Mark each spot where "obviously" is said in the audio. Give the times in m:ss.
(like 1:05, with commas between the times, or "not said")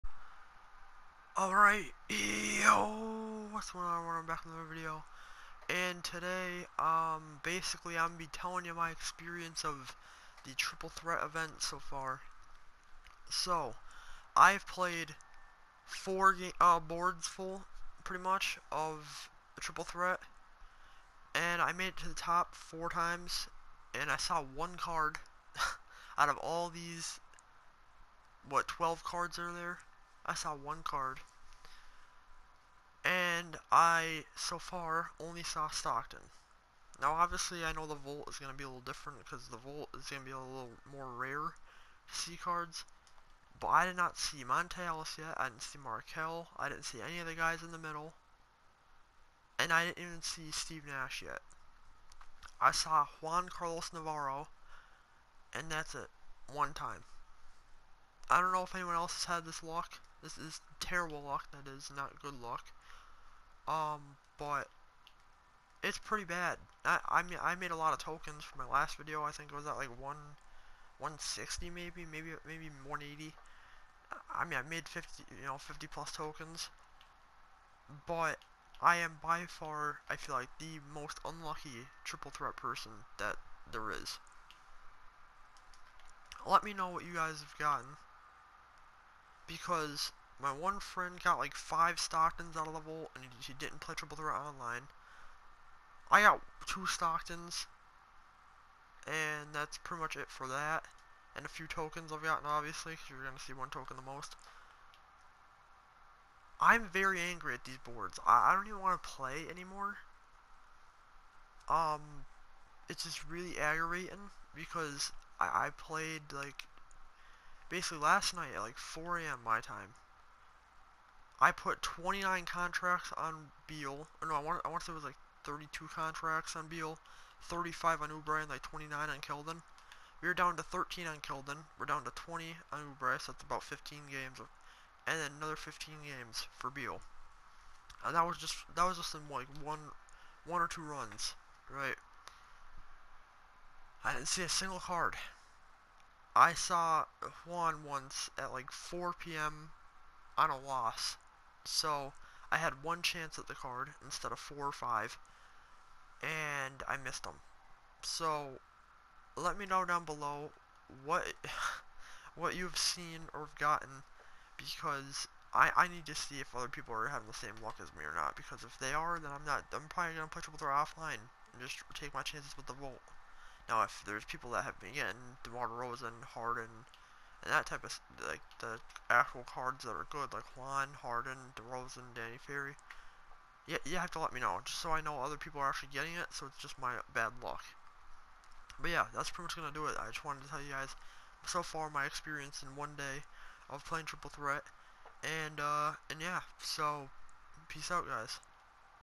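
0:37, 1:42.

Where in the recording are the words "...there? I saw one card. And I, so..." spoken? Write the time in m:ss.
0:29.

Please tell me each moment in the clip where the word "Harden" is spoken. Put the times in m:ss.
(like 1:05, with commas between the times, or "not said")
2:56, 3:01.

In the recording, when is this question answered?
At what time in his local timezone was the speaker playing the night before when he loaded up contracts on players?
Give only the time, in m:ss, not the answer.
1:58.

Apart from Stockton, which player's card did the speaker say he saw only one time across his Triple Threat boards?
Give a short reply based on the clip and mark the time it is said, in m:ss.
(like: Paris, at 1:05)
Juan Carlos Navarro, at 0:53.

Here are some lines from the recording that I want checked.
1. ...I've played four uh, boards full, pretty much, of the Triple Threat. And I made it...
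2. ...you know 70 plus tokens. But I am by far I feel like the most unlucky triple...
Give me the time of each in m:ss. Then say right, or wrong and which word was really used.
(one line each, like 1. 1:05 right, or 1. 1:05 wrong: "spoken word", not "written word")
1. 0:14 right
2. 1:15 wrong: "50", not "70".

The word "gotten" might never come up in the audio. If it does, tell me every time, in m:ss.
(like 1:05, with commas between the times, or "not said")
1:27, 1:42, 2:43.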